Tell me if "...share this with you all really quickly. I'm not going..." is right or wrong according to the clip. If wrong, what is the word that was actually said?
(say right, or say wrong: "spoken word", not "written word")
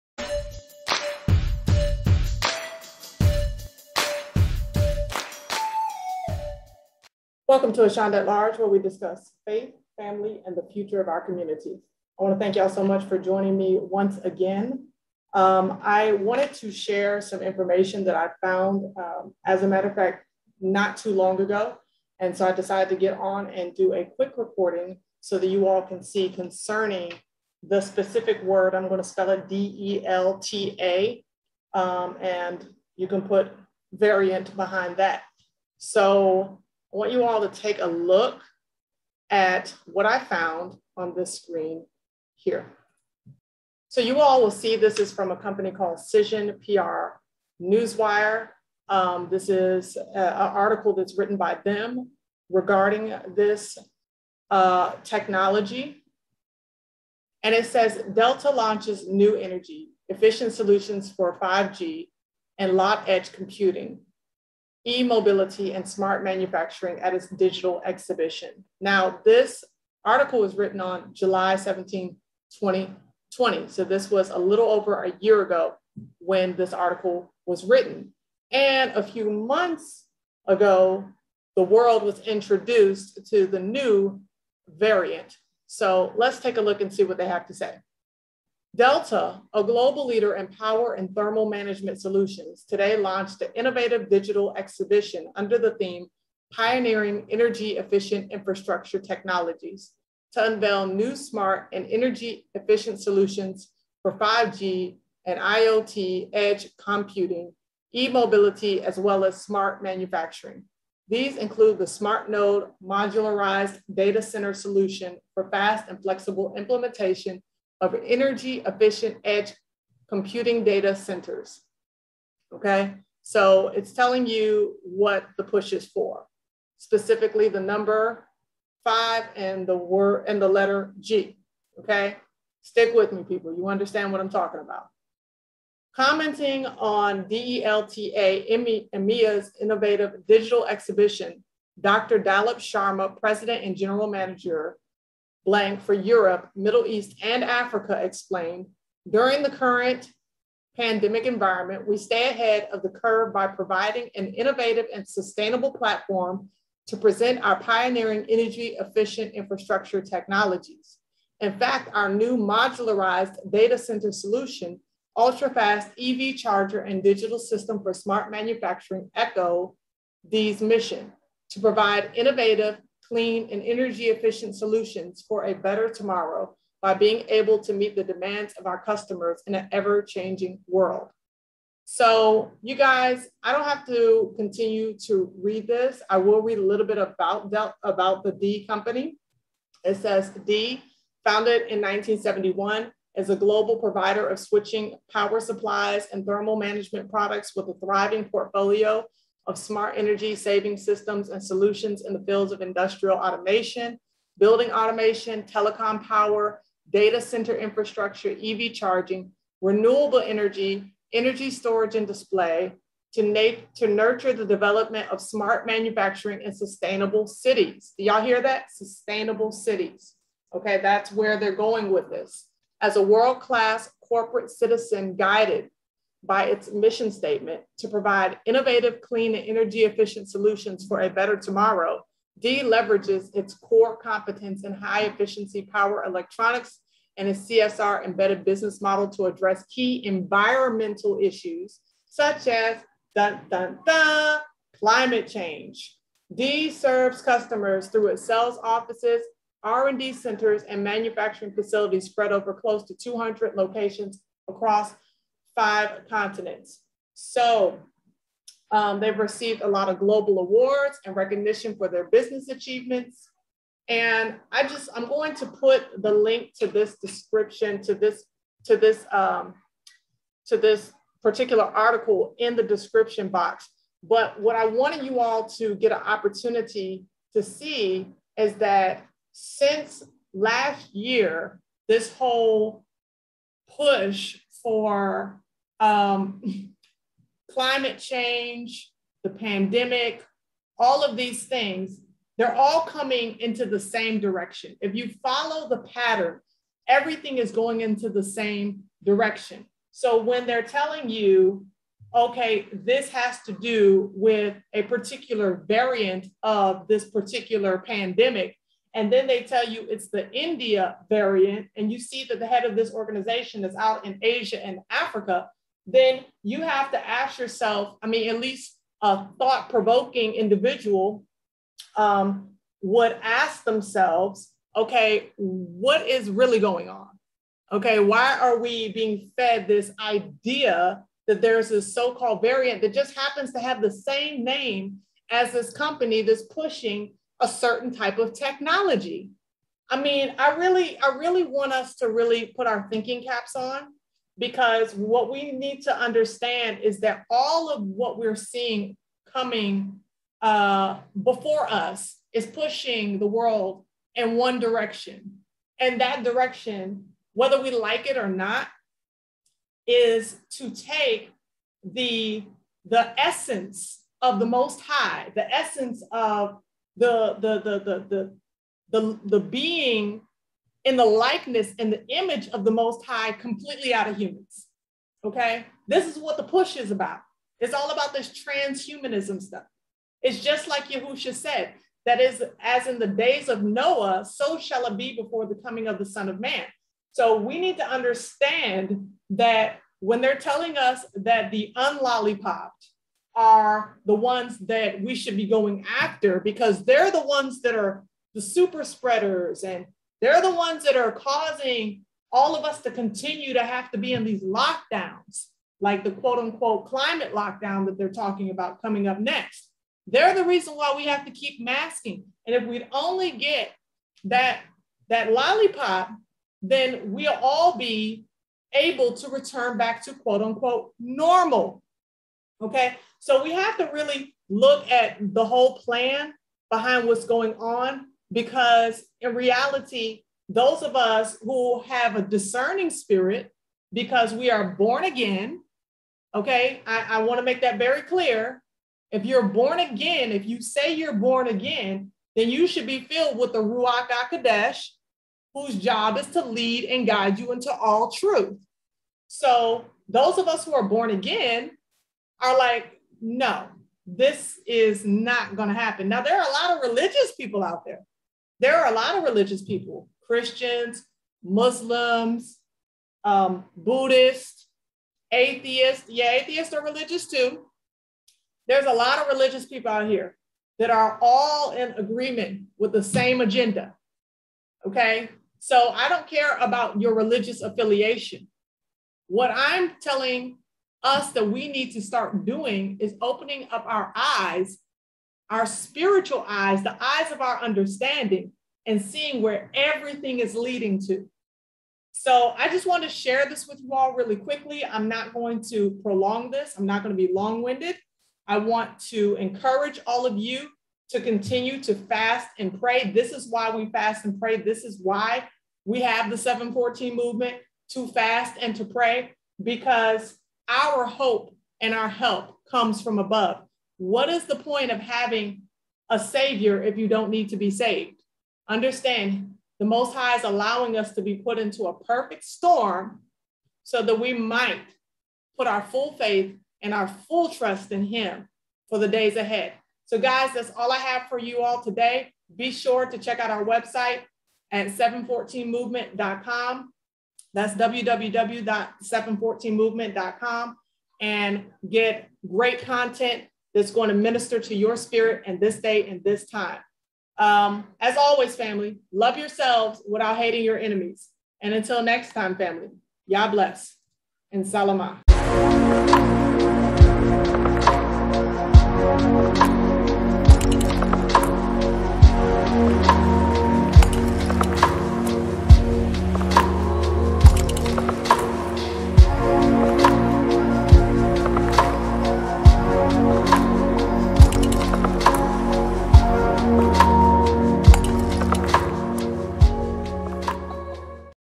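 right.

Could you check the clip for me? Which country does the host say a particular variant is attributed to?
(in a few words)
India.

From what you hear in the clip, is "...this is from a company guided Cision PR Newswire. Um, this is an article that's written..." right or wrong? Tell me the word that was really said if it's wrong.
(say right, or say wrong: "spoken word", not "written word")
wrong: "called", not "guided".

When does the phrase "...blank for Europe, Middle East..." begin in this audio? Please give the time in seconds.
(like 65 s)
145 s.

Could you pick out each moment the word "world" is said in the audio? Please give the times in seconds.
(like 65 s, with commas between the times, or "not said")
81 s, 180 s, 223 s, 353 s.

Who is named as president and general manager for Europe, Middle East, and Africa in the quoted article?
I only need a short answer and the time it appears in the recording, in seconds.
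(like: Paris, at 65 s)
Dr. Dalip Sharma, at 141 s.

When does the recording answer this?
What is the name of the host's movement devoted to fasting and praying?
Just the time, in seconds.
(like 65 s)
506 s.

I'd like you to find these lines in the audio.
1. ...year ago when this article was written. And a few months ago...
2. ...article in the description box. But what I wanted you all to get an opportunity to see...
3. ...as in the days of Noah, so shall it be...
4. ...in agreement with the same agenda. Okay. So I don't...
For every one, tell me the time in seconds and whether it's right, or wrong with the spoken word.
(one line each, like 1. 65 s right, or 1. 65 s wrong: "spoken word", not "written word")
1. 75 s right
2. 271 s right
3. 382 s right
4. 471 s right.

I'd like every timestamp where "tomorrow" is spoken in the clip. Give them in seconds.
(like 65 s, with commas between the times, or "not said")
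175 s, 231 s.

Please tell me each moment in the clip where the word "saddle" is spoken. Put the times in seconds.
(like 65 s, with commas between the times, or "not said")
not said.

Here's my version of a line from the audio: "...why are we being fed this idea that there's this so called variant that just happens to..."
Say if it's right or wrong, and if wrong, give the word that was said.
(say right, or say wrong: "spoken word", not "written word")
right.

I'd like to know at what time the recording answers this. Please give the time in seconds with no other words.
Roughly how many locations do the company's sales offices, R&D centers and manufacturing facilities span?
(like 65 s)
252 s.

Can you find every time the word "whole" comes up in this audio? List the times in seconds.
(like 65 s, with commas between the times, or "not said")
282 s, 425 s.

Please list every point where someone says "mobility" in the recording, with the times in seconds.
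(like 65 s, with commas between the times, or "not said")
64 s, 107 s.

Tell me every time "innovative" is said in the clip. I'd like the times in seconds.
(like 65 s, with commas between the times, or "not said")
93 s, 139 s, 154 s, 172 s, 228 s.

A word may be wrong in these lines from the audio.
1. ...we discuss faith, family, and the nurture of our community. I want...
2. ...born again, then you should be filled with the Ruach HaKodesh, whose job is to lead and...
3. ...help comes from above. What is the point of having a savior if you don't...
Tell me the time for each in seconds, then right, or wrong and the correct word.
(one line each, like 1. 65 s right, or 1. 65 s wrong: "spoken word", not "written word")
1. 8 s wrong: "future", not "nurture"
2. 441 s right
3. 512 s right.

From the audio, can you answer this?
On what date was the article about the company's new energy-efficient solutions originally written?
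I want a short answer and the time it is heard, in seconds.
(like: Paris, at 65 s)
July 17, 2020, at 71 s.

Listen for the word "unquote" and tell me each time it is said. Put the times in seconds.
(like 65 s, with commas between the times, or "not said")
406 s, 420 s.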